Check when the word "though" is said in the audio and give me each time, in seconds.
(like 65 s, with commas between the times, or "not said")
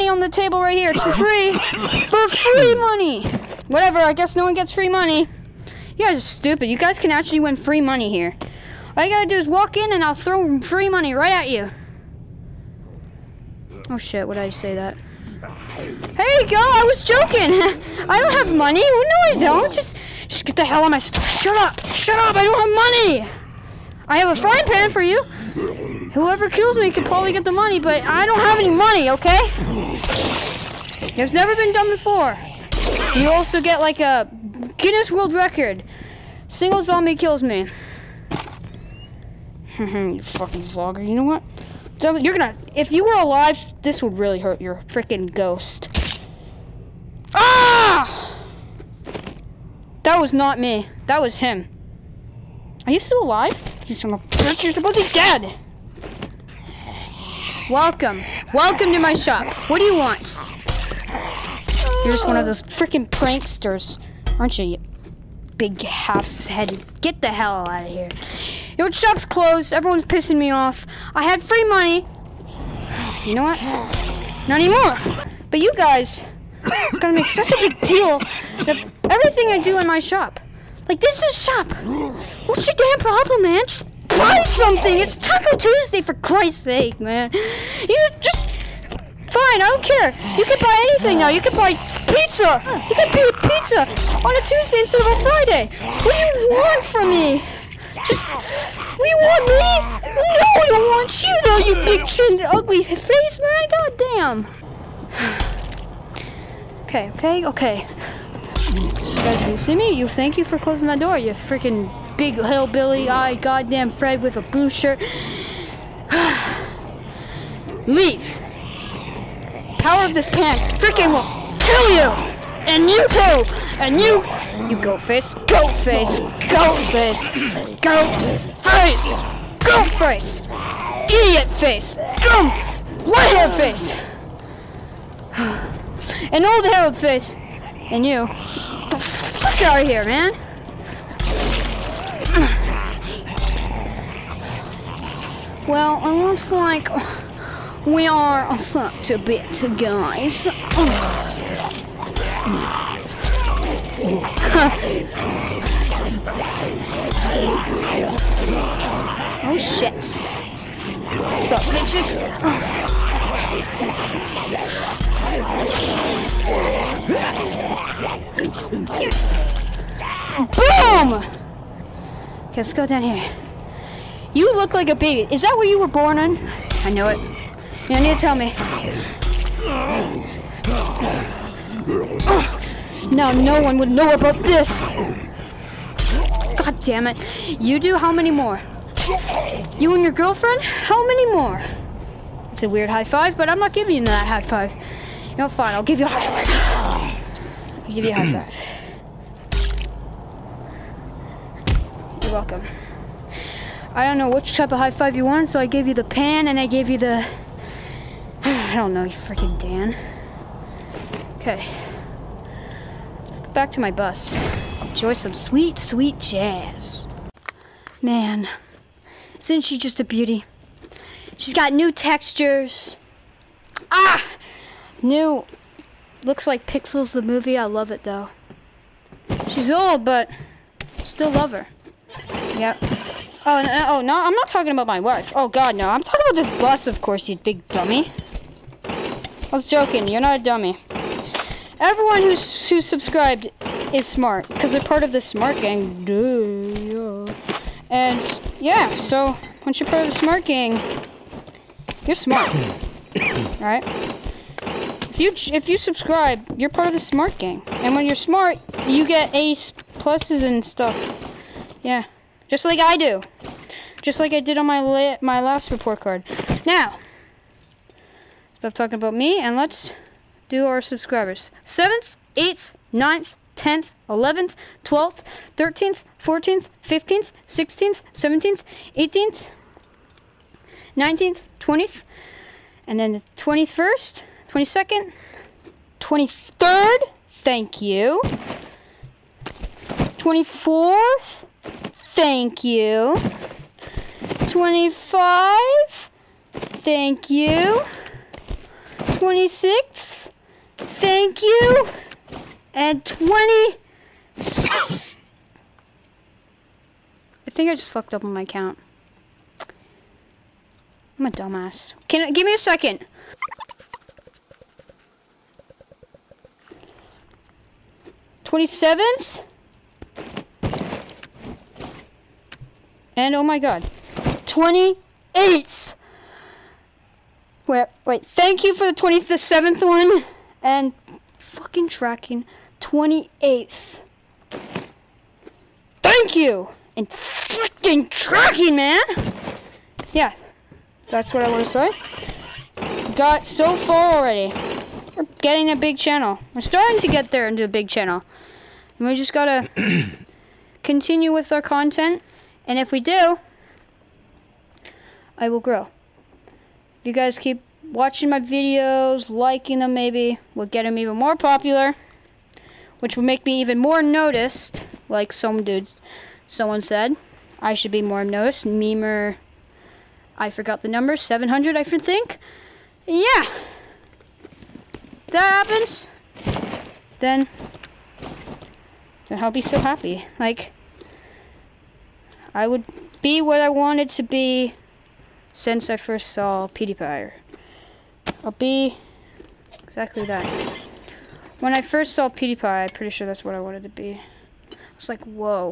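101 s, 228 s.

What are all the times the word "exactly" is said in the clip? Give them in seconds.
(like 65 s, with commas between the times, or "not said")
389 s.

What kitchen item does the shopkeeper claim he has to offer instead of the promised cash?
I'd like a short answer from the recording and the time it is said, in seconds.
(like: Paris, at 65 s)
frying pan, at 24 s.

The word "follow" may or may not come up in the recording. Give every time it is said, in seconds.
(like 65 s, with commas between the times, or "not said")
not said.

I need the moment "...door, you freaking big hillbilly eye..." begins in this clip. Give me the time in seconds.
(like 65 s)
110 s.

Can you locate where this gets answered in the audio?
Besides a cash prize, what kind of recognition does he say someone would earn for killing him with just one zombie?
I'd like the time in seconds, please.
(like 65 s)
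34 s.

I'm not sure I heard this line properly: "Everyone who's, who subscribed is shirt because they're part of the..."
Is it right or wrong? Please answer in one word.
wrong.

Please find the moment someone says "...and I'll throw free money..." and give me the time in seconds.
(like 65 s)
9 s.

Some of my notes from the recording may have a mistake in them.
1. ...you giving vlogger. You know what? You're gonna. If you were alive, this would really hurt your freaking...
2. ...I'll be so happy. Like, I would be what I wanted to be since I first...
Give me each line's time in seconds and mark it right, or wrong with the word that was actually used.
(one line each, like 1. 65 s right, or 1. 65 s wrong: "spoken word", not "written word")
1. 39 s wrong: "fucking", not "giving"
2. 379 s right.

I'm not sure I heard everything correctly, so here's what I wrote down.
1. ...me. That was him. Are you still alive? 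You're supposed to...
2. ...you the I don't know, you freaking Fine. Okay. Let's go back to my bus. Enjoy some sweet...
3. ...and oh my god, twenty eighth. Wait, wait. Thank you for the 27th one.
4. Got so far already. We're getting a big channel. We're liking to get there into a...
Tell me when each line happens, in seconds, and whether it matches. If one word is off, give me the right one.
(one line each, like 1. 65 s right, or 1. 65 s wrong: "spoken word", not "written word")
1. 50 s right
2. 206 s wrong: "Dan", not "Fine"
3. 323 s right
4. 343 s wrong: "starting", not "liking".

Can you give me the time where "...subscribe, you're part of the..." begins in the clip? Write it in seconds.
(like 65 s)
255 s.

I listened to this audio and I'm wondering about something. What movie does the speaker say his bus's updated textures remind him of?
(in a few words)
Pixels.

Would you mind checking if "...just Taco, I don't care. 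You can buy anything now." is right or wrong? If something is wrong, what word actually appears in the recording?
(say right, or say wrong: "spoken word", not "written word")
wrong: "Fine", not "Taco".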